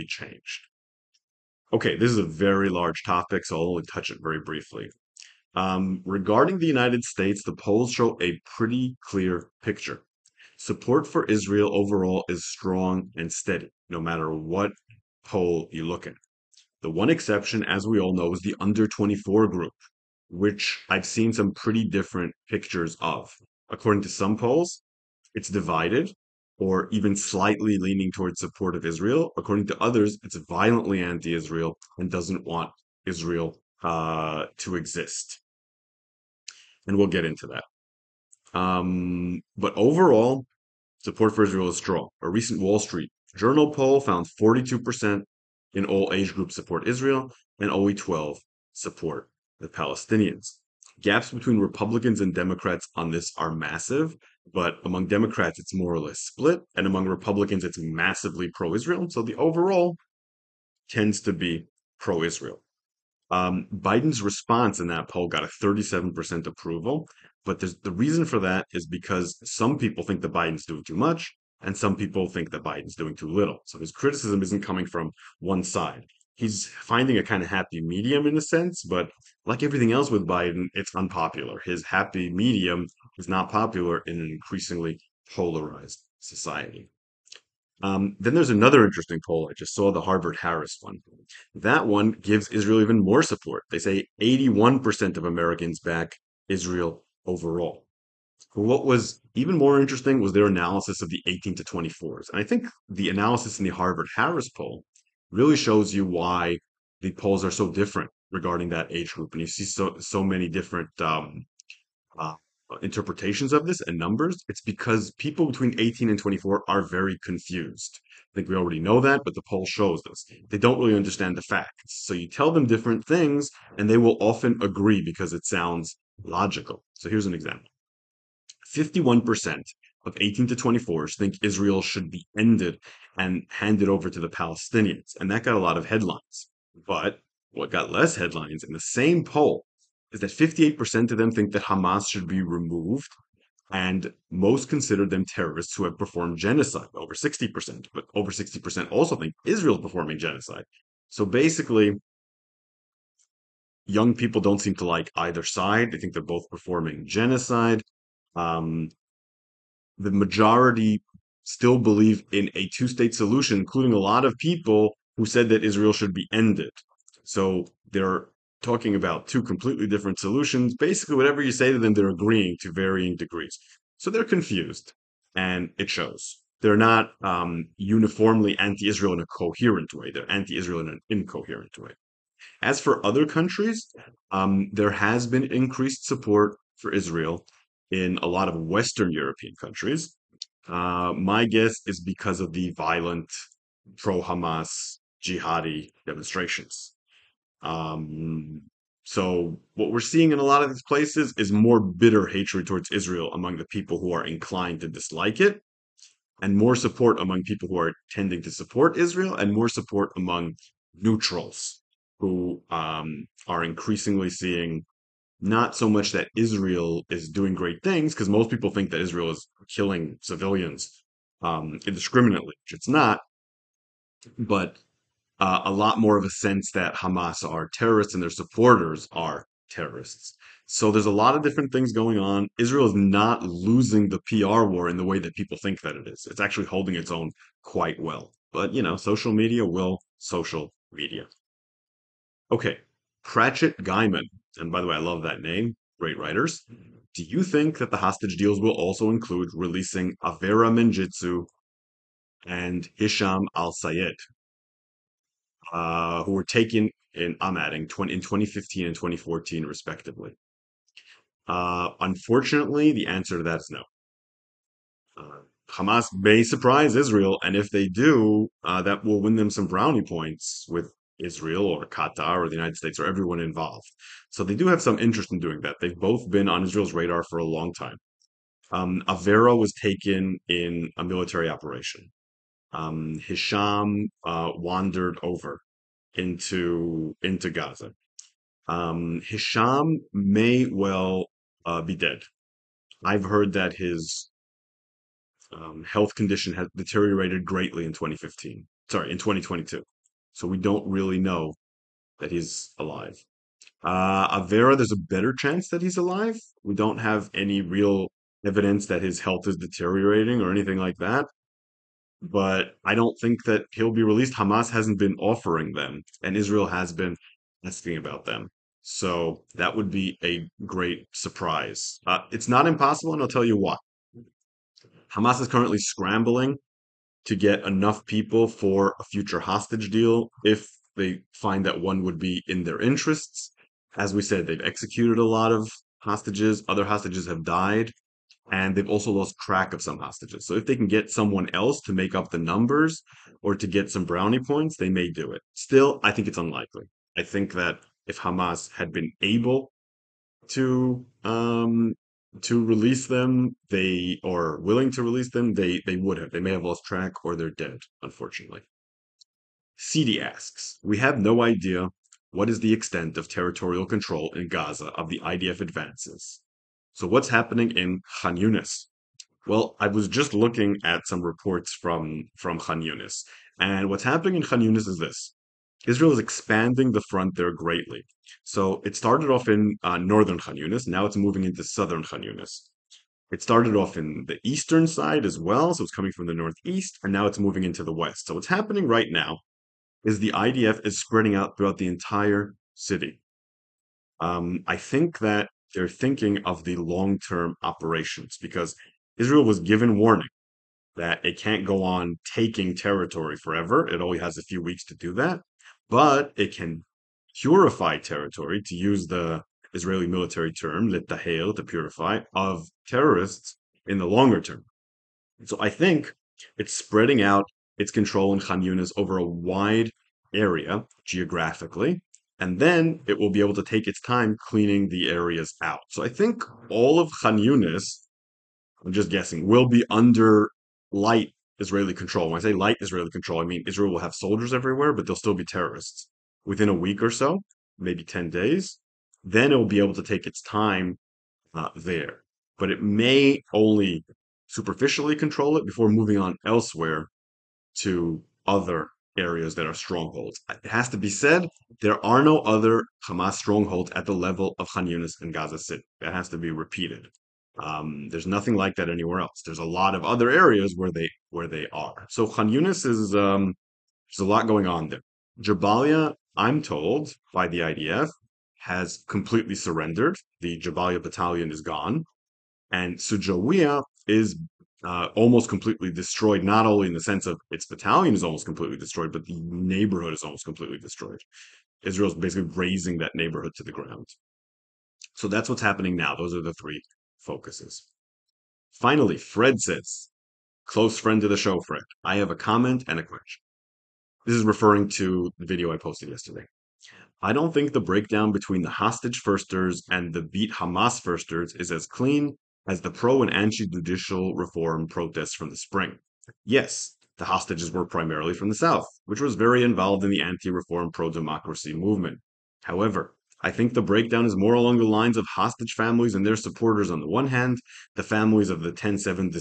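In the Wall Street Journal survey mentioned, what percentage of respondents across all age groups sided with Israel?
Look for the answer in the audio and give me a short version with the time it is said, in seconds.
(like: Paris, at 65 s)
42%, at 44 s.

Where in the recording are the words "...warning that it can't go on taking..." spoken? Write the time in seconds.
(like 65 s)
399 s.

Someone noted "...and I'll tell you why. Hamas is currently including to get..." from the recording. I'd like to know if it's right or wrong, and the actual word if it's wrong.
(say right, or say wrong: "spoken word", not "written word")
wrong: "scrambling", not "including".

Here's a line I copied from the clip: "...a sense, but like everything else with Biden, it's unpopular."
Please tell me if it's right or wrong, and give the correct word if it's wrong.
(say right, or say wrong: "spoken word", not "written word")
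right.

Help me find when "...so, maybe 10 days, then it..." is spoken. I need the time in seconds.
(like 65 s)
437 s.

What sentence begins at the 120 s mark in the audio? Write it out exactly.
They don't really understand the facts.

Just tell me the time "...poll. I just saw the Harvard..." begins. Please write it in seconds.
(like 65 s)
89 s.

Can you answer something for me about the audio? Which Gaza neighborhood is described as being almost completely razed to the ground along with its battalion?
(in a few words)
Shujaiya.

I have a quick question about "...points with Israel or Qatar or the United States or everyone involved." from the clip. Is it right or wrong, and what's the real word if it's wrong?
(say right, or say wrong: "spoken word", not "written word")
right.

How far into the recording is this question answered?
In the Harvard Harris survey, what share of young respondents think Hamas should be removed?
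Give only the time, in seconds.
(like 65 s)
140 s.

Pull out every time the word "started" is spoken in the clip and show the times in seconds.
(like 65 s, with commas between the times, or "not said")
378 s, 383 s.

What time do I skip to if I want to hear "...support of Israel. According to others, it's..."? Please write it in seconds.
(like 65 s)
28 s.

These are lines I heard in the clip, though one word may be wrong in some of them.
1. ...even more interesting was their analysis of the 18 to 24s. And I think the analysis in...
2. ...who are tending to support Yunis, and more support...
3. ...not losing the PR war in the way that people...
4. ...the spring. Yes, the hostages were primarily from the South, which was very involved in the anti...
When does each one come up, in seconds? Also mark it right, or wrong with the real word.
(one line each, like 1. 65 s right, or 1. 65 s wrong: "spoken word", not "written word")
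1. 99 s right
2. 207 s wrong: "Israel", not "Yunis"
3. 232 s right
4. 505 s right.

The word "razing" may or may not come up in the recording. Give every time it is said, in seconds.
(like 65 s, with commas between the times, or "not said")
482 s.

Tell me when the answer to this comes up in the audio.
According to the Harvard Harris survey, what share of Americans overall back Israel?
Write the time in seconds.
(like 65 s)
94 s.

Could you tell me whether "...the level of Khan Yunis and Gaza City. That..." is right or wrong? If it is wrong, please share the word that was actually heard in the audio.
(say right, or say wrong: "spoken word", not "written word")
right.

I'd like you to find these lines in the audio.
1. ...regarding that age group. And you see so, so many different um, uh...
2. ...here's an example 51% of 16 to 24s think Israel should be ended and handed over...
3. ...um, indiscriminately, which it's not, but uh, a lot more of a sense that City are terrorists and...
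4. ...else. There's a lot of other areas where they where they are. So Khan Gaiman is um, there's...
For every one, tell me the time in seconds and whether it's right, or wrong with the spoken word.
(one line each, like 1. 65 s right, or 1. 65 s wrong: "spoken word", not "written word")
1. 108 s right
2. 127 s wrong: "18", not "16"
3. 221 s wrong: "Hamas", not "City"
4. 459 s wrong: "Yunis", not "Gaiman".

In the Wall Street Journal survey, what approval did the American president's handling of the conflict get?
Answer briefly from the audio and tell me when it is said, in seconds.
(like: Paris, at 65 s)
37%, at 65 s.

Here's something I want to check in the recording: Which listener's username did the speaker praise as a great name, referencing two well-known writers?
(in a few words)
Pratchett Gaiman.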